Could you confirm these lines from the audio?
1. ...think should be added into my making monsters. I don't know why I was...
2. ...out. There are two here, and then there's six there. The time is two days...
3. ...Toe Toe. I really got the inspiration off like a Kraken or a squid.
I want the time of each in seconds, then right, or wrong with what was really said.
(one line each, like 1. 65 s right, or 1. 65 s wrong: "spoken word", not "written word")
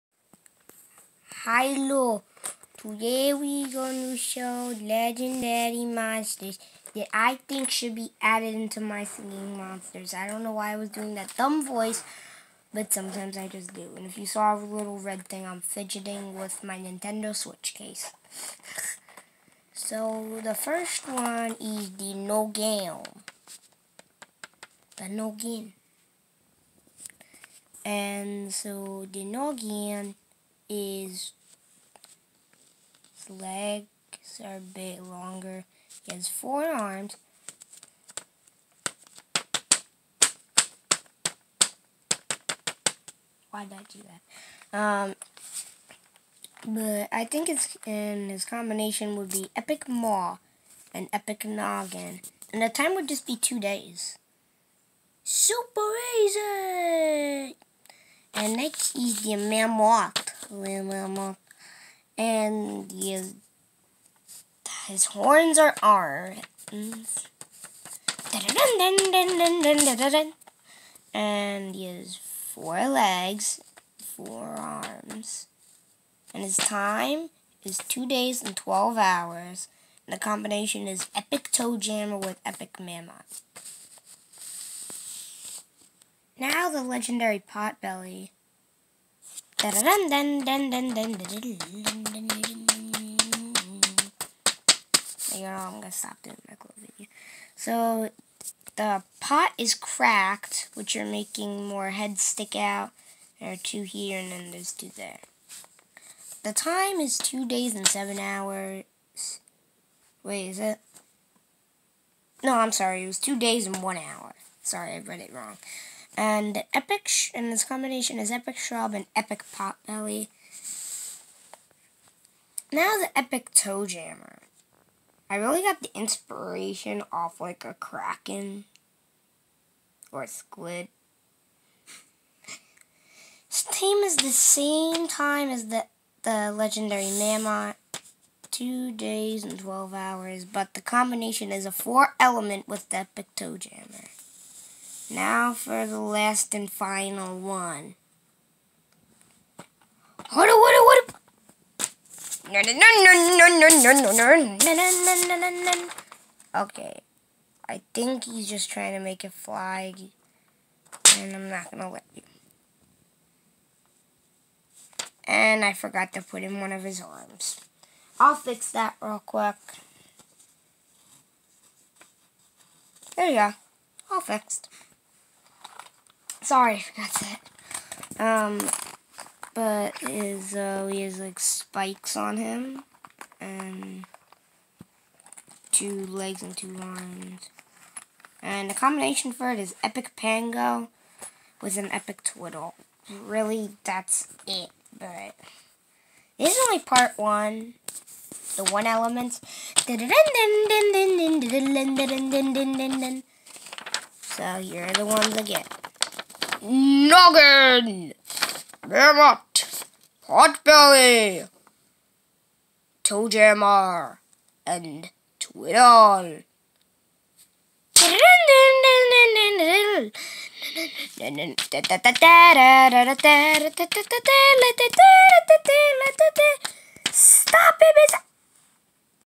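1. 7 s wrong: "singing", not "making"
2. 102 s wrong: "two", not "six"
3. 123 s wrong: "Jammer", not "Toe".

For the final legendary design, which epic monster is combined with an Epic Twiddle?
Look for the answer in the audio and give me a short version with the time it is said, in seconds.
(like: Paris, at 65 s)
Epic Pango, at 189 s.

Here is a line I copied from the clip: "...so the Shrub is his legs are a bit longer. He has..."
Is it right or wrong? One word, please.
wrong.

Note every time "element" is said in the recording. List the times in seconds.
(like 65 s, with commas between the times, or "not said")
142 s, 198 s.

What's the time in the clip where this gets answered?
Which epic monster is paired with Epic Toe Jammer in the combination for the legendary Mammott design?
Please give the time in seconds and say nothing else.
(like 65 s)
82 s.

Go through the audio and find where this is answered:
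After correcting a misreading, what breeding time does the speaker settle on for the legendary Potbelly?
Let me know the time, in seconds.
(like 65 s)
113 s.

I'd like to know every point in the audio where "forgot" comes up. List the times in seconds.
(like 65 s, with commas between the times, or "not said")
165 s, 176 s.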